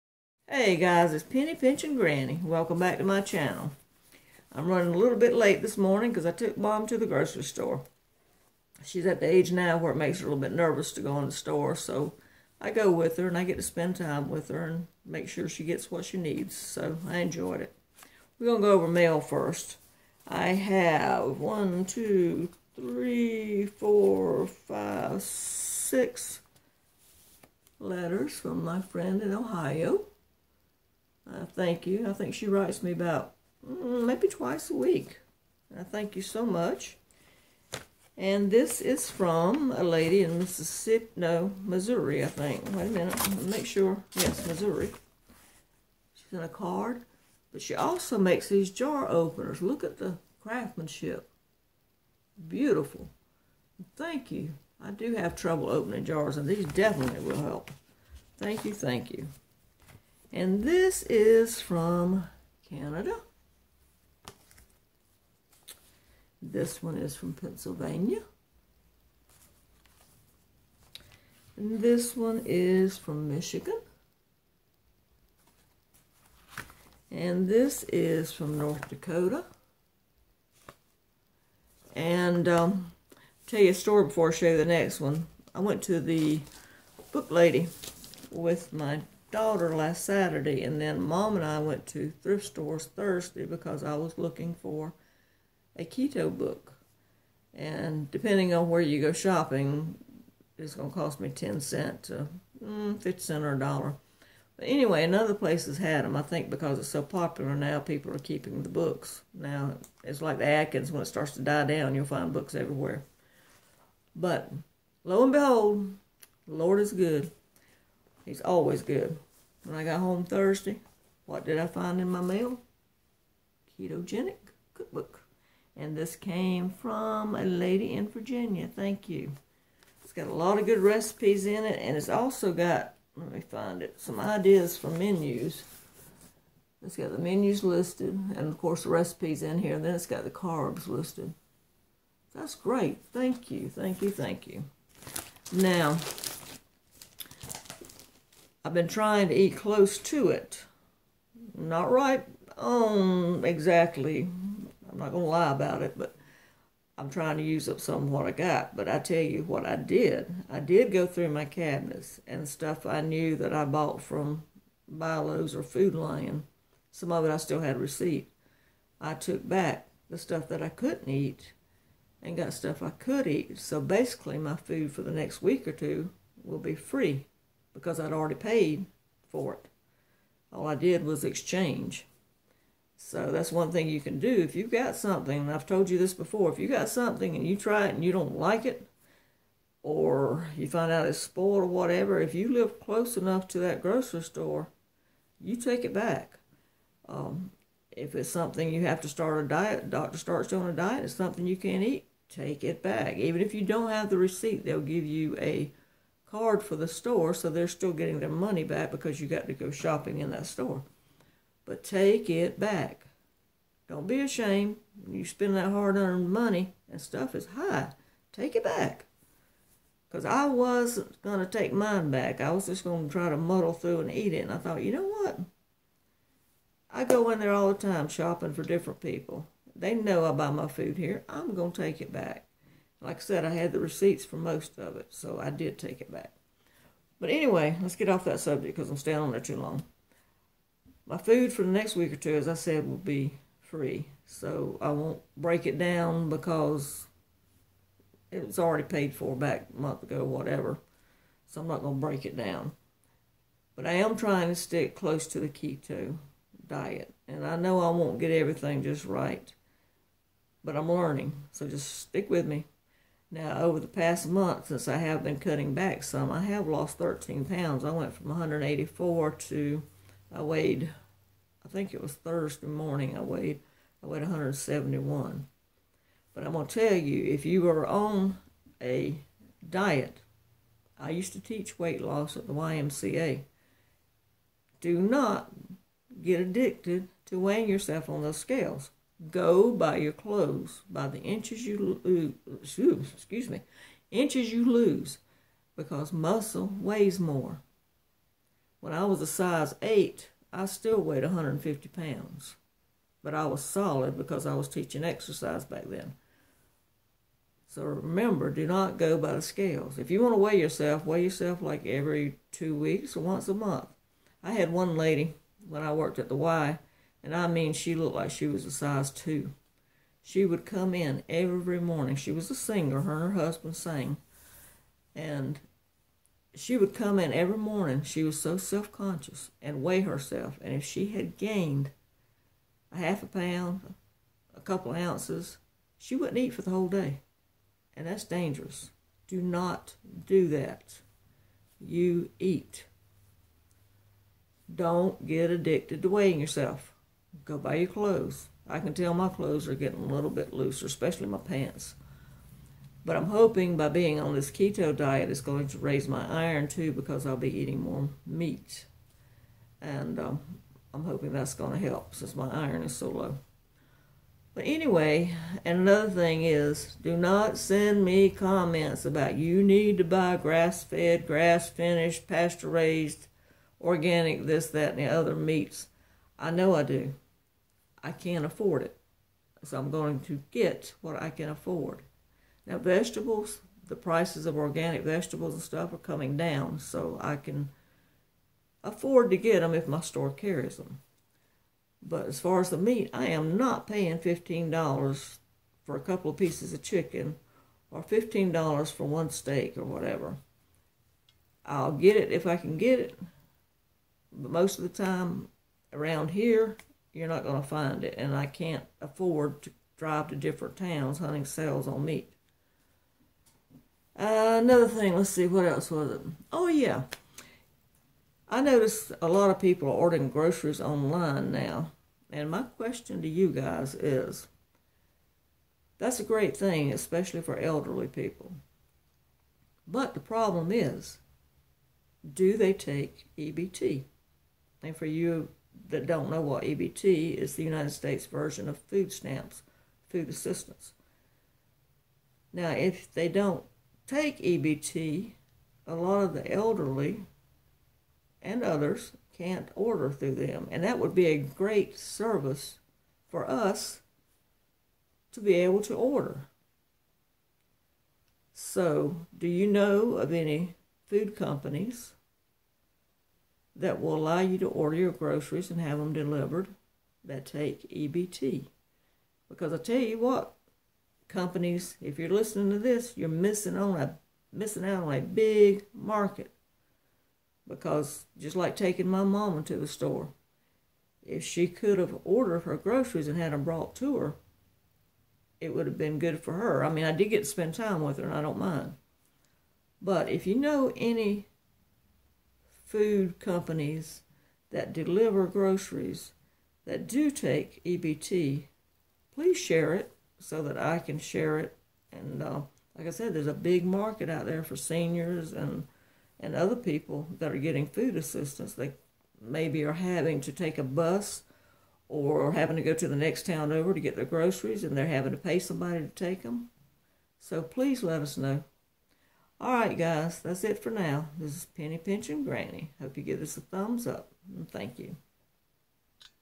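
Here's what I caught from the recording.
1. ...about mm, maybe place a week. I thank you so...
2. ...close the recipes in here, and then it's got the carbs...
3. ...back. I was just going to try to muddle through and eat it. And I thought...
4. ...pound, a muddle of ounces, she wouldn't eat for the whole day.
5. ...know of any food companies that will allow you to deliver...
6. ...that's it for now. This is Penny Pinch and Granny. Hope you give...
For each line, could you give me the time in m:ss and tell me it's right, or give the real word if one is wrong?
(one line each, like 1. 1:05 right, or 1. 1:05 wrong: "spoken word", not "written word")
1. 0:32 wrong: "twice", not "place"
2. 2:18 wrong: "course", not "close"
3. 3:42 right
4. 5:33 wrong: "couple", not "muddle"
5. 7:39 wrong: "order", not "deliver"
6. 8:40 right.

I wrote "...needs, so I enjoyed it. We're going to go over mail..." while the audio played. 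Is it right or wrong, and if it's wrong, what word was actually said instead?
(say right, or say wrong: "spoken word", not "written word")
right.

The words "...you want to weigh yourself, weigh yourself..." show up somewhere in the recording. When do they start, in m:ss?
5:10.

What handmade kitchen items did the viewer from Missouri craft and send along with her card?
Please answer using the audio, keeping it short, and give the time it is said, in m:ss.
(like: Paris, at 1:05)
jar openers, at 0:48.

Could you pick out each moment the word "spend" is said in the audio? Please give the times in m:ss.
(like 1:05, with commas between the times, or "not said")
0:13, 3:35, 8:07.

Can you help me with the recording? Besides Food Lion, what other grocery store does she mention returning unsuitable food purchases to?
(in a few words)
BI-LO's.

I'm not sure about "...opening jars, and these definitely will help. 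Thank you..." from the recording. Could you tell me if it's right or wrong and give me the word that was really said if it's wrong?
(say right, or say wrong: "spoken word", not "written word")
right.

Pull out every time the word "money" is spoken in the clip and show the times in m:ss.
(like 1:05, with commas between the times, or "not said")
3:28, 3:36.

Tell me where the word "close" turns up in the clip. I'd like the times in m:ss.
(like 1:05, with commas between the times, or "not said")
2:29, 3:12, 4:14.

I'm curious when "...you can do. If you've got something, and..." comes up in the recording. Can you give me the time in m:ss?
3:03.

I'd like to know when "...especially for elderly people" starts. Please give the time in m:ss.
7:06.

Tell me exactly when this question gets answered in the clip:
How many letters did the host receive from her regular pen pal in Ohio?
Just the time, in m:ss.
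0:25.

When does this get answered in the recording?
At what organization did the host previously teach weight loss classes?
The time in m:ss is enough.
4:42.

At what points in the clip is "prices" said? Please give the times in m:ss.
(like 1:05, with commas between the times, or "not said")
6:23.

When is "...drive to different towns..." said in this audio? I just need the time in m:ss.
6:49.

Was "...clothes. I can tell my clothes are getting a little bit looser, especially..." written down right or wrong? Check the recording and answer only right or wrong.
right.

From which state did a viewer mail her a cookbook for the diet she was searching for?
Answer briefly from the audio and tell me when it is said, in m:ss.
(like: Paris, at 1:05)
Virginia, at 2:08.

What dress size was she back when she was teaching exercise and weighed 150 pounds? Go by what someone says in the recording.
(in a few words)
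size 8.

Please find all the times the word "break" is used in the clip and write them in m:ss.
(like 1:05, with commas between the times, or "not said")
4:05, 4:12.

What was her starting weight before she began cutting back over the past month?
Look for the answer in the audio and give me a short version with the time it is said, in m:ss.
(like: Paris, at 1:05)
184, at 4:28.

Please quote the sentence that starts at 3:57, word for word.
But anyway, let's get off that subject because I'm staying on there too long.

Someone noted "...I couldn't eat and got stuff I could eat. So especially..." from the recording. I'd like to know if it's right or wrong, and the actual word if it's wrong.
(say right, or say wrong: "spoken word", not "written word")
wrong: "basically", not "especially".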